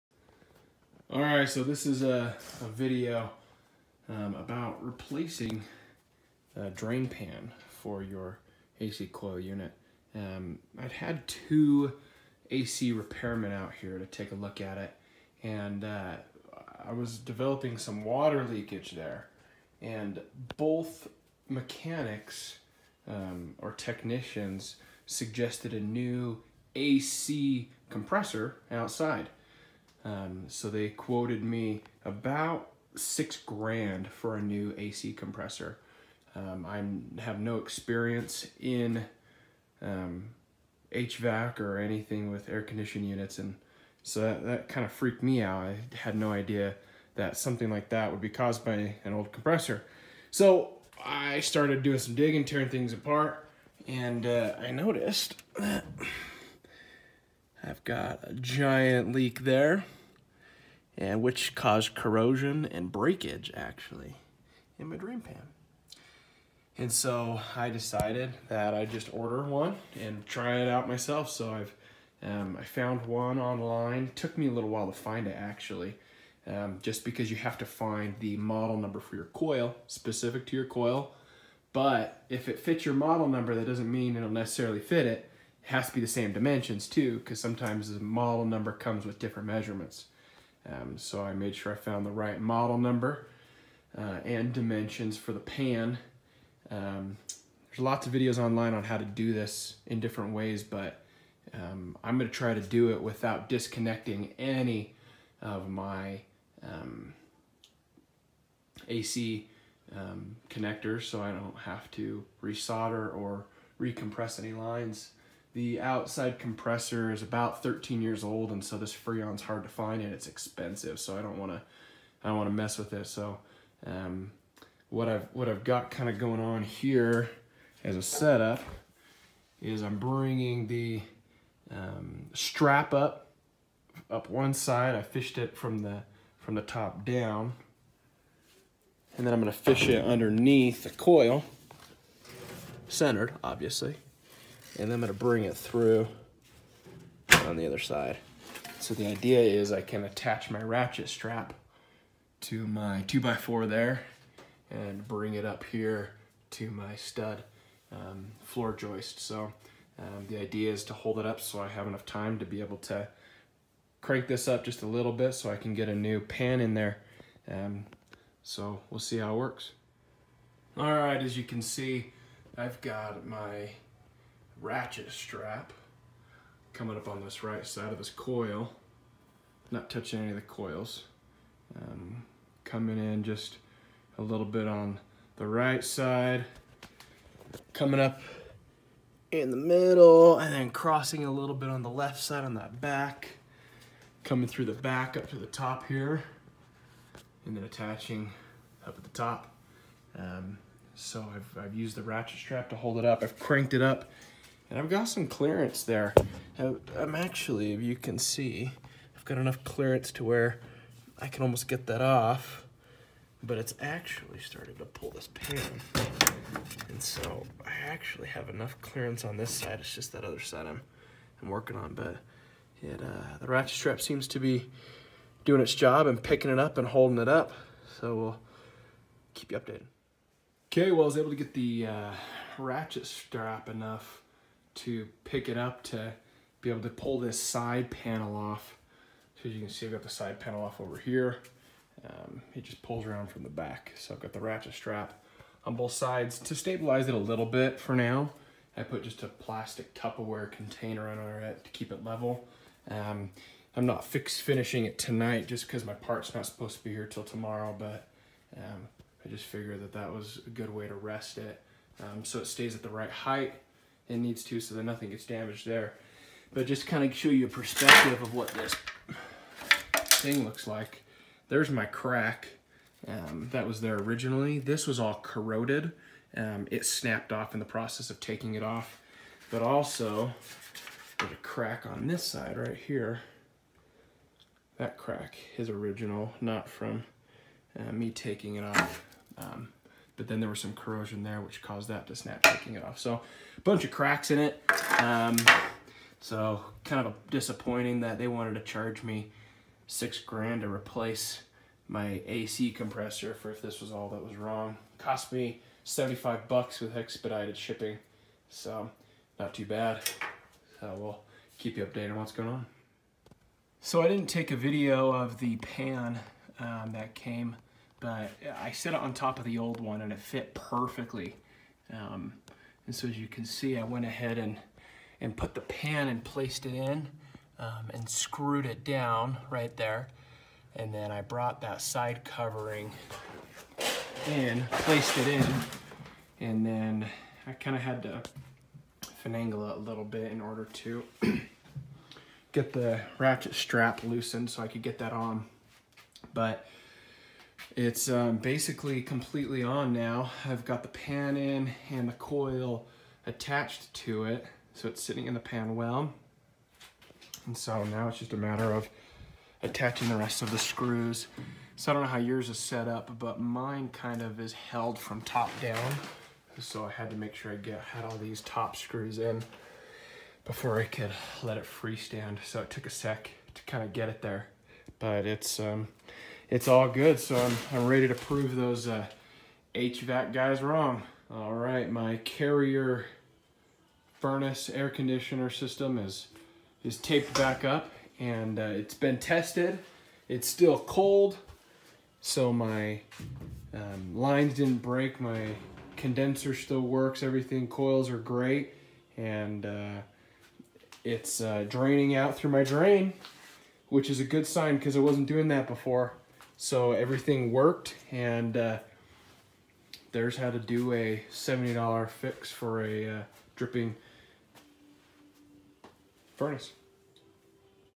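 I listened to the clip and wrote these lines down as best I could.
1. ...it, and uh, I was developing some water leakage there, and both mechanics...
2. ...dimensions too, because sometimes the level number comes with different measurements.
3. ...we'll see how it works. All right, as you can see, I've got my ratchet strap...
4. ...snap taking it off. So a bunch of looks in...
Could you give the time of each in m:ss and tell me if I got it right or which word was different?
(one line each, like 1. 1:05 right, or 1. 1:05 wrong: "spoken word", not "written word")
1. 0:14 right
2. 1:26 wrong: "model", not "level"
3. 2:48 right
4. 4:52 wrong: "cracks", not "looks".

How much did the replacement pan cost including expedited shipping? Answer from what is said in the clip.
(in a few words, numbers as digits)
$75.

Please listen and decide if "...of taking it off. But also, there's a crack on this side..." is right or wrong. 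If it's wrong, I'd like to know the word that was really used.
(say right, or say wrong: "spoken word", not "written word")
right.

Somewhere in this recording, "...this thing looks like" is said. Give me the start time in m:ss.
4:28.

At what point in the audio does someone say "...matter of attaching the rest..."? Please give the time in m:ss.
5:58.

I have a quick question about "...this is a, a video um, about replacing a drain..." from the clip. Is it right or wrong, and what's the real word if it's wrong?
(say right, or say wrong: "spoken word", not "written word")
right.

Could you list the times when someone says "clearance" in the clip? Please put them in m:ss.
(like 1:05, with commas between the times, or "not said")
3:25, 3:29, 3:38.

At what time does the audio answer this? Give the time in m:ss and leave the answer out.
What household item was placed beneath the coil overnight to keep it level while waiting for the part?
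4:09.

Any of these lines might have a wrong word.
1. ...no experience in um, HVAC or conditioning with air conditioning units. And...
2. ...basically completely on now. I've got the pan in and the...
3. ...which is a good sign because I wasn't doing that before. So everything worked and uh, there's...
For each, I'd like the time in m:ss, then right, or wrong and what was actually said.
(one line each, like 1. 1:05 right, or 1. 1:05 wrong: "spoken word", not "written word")
1. 0:37 wrong: "anything", not "conditioning"
2. 5:48 right
3. 6:43 right.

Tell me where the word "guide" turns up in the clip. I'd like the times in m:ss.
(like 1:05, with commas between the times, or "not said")
not said.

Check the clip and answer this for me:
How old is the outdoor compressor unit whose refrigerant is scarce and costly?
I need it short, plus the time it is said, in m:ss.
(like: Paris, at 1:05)
13 years, at 1:57.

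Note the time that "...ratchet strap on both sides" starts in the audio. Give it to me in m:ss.
4:04.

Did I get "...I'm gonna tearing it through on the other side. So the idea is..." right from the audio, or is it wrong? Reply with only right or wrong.
wrong.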